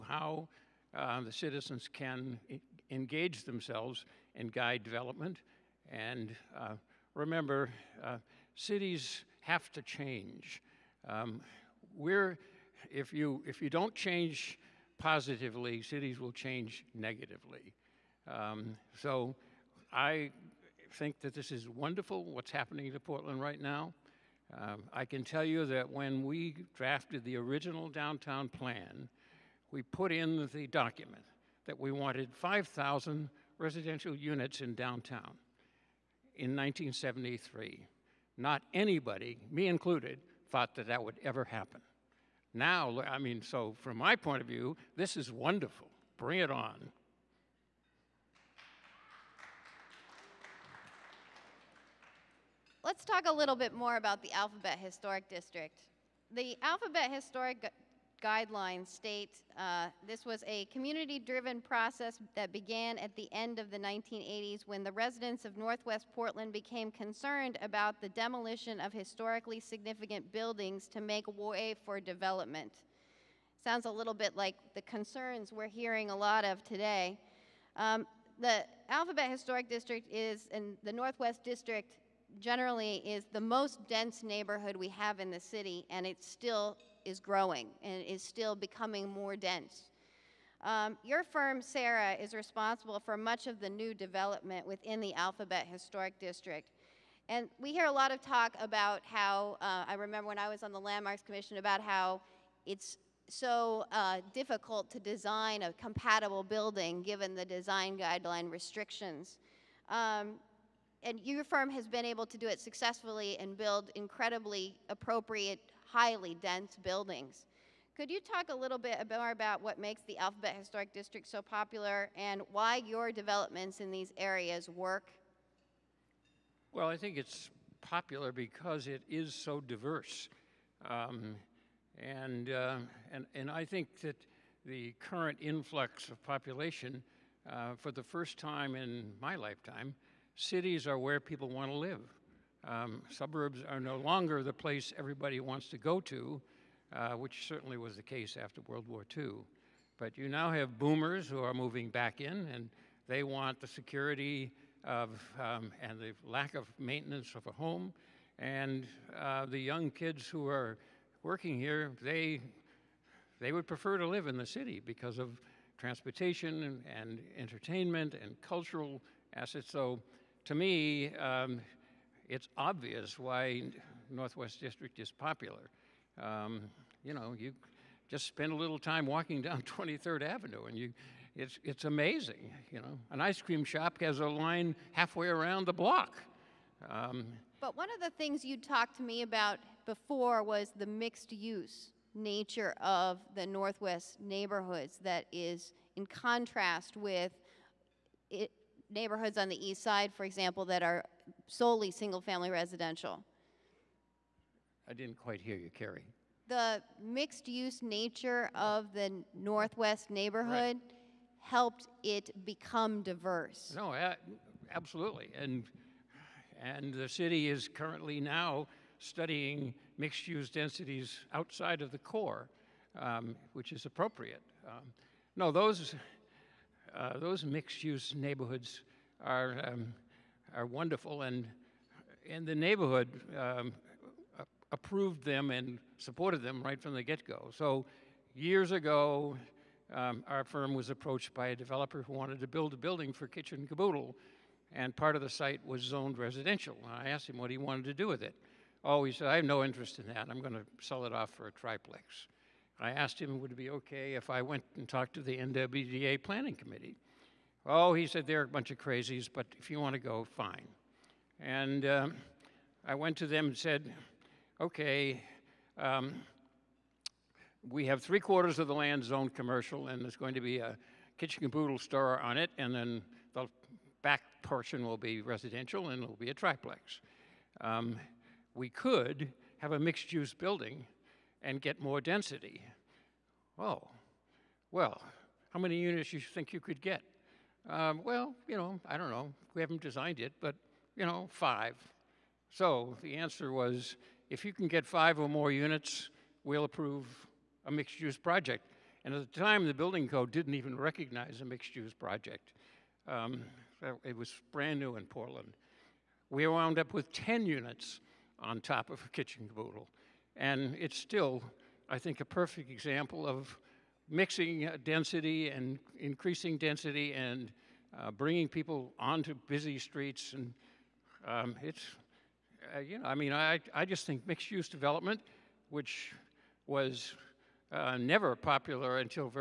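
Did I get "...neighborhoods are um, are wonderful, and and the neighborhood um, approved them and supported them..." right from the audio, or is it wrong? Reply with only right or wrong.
right.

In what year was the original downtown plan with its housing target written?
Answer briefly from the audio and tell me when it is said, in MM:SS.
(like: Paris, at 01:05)
1973, at 00:36.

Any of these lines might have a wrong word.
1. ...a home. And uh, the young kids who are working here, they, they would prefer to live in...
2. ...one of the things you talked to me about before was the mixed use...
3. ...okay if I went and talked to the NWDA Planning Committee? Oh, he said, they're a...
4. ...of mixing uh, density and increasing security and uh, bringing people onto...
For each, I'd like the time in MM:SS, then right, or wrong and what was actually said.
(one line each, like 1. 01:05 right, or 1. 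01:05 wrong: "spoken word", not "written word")
1. 02:37 right
2. 03:07 right
3. 04:13 right
4. 05:13 wrong: "density", not "security".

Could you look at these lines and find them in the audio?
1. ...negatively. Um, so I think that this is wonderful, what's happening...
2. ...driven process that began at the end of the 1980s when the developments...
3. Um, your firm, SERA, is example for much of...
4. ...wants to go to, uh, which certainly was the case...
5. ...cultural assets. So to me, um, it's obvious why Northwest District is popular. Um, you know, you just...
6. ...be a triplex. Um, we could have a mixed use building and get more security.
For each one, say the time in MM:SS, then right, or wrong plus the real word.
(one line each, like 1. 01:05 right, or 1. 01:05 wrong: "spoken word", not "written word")
1. 00:16 right
2. 01:01 wrong: "residents", not "developments"
3. 01:30 wrong: "responsible", not "example"
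4. 02:25 right
5. 02:48 right
6. 04:36 wrong: "density", not "security".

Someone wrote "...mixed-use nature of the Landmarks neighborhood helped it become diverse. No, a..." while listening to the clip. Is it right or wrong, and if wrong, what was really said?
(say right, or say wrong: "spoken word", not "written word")
wrong: "Northwest", not "Landmarks".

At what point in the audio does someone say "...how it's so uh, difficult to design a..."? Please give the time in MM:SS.
01:41.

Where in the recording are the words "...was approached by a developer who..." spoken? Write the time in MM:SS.
04:00.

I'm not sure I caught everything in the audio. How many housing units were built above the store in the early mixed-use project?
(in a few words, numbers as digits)
10.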